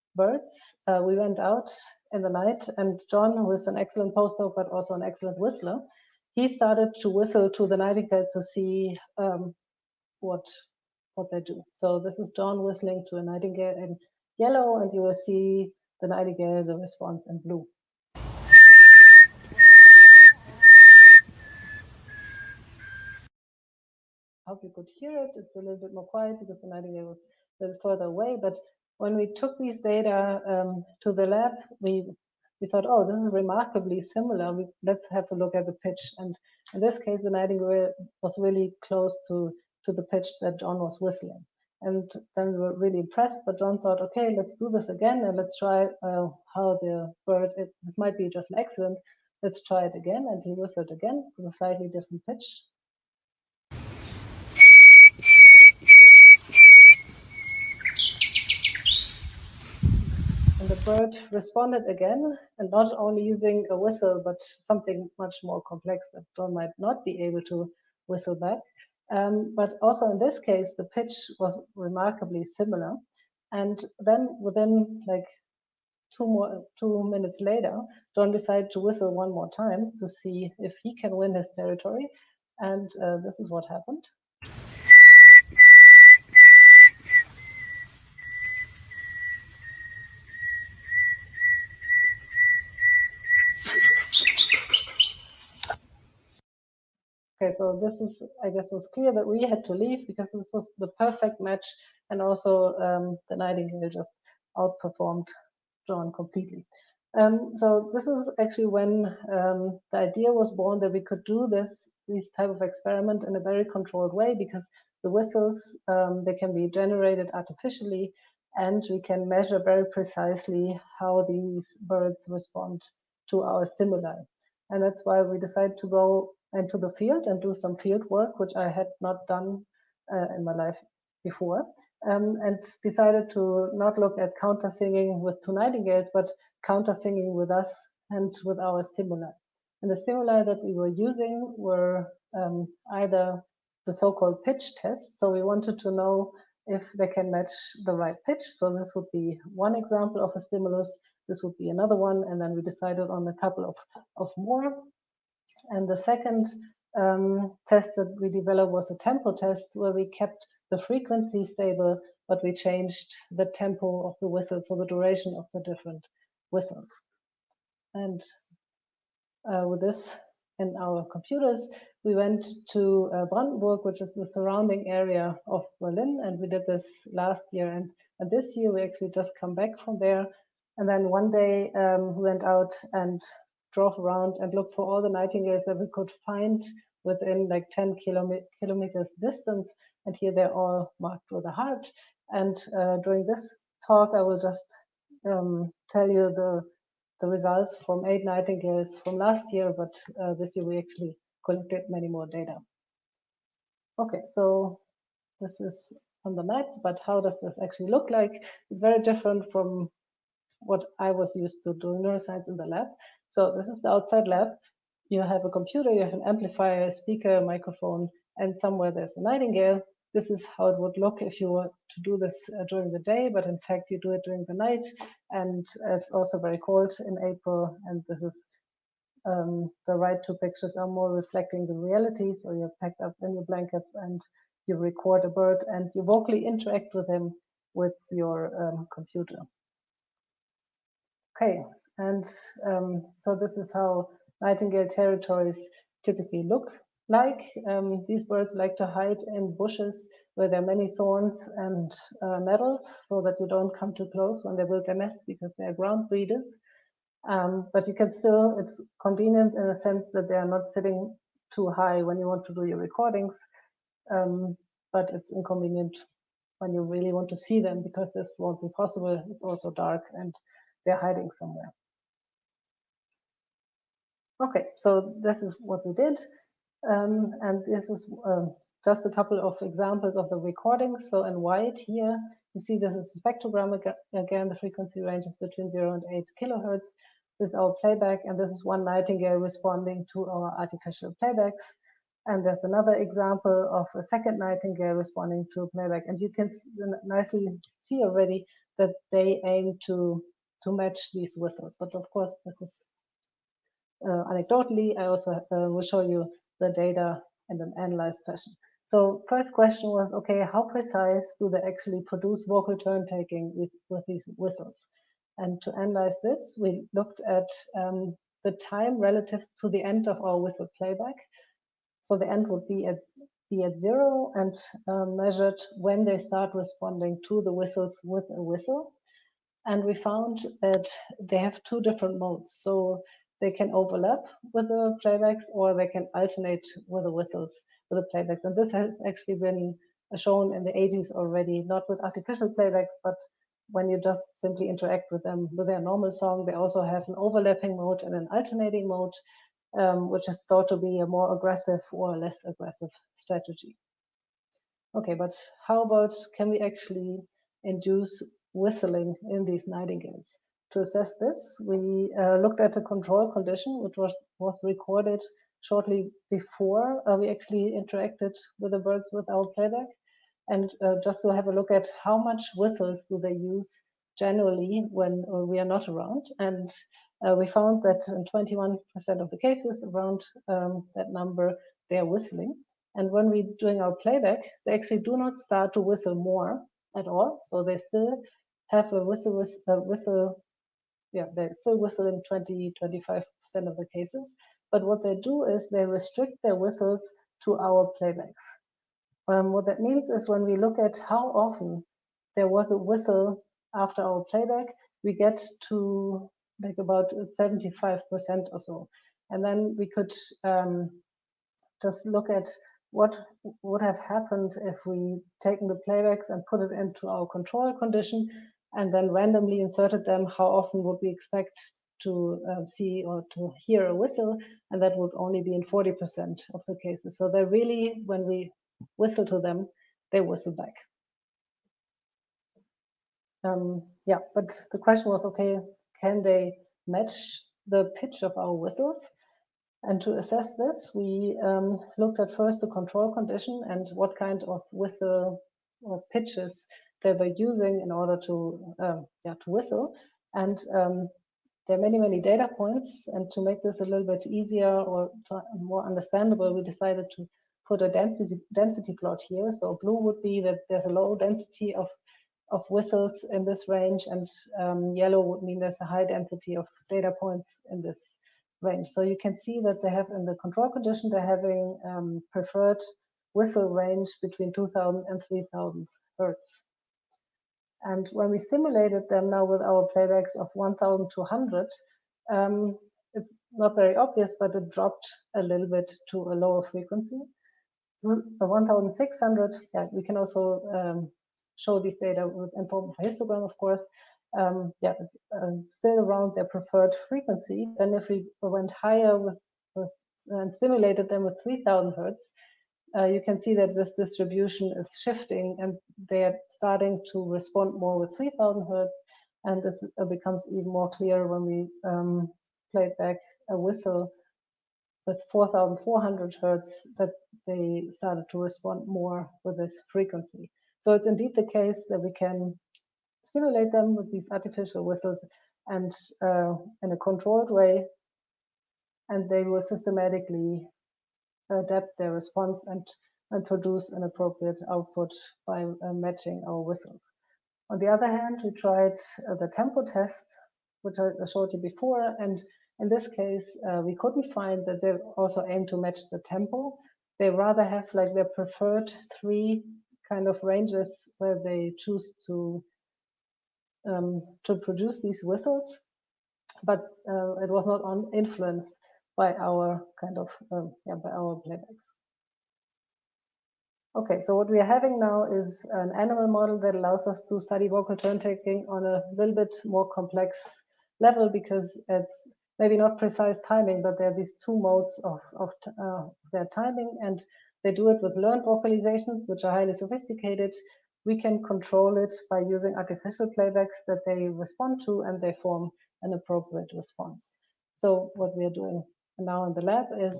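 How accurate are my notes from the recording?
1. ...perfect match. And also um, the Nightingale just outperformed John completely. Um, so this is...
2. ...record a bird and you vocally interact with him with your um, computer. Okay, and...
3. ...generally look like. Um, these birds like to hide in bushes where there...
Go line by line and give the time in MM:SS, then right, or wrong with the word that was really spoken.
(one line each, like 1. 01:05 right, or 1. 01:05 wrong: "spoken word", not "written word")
1. 01:40 right
2. 03:54 right
3. 04:06 wrong: "typically", not "generally".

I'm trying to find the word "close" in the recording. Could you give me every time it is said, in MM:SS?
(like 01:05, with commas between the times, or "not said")
00:38, 04:14.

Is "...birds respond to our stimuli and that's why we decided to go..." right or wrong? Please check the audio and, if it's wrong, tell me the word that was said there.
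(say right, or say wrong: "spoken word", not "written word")
right.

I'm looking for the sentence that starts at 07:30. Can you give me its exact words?
And um, there are many, many data points.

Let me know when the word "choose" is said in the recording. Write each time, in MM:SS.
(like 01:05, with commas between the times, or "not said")
09:11.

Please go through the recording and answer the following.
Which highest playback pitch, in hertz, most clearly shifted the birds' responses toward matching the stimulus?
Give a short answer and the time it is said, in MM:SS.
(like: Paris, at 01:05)
4400 hertz, at 08:35.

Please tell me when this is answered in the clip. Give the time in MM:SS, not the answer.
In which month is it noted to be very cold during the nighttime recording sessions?
03:47.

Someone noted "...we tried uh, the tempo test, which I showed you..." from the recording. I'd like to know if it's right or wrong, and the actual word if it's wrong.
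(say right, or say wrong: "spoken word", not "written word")
right.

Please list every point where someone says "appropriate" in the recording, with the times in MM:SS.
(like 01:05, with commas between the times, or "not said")
08:54, 09:46.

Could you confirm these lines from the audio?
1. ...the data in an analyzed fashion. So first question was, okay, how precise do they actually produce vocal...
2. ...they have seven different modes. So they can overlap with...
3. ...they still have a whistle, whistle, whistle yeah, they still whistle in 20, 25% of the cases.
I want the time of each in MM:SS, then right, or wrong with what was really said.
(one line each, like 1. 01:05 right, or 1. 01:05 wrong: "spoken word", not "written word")
1. 05:06 right
2. 05:31 wrong: "two", not "seven"
3. 06:27 right.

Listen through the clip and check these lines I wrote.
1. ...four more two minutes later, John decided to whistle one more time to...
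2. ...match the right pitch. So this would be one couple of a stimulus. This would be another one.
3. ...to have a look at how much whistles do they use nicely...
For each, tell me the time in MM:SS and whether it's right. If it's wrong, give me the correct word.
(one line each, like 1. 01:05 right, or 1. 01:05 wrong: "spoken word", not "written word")
1. 01:16 wrong: "two", not "four"
2. 02:27 wrong: "example", not "couple"
3. 06:11 wrong: "generally", not "nicely".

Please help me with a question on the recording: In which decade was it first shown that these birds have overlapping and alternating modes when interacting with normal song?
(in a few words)
1980s.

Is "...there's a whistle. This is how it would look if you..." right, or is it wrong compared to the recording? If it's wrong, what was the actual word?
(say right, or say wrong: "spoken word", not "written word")
wrong: "nightingale", not "whistle".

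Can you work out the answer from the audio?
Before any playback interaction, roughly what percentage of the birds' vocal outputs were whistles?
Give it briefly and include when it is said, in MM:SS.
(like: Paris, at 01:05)
21%, at 06:18.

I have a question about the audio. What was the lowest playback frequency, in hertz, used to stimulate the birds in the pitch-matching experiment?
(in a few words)
1200 hertz.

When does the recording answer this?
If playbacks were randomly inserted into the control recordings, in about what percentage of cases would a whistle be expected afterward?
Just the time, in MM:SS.
07:05.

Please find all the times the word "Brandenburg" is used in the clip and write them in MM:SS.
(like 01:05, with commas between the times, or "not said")
02:53.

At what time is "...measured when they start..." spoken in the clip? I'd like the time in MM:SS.
05:25.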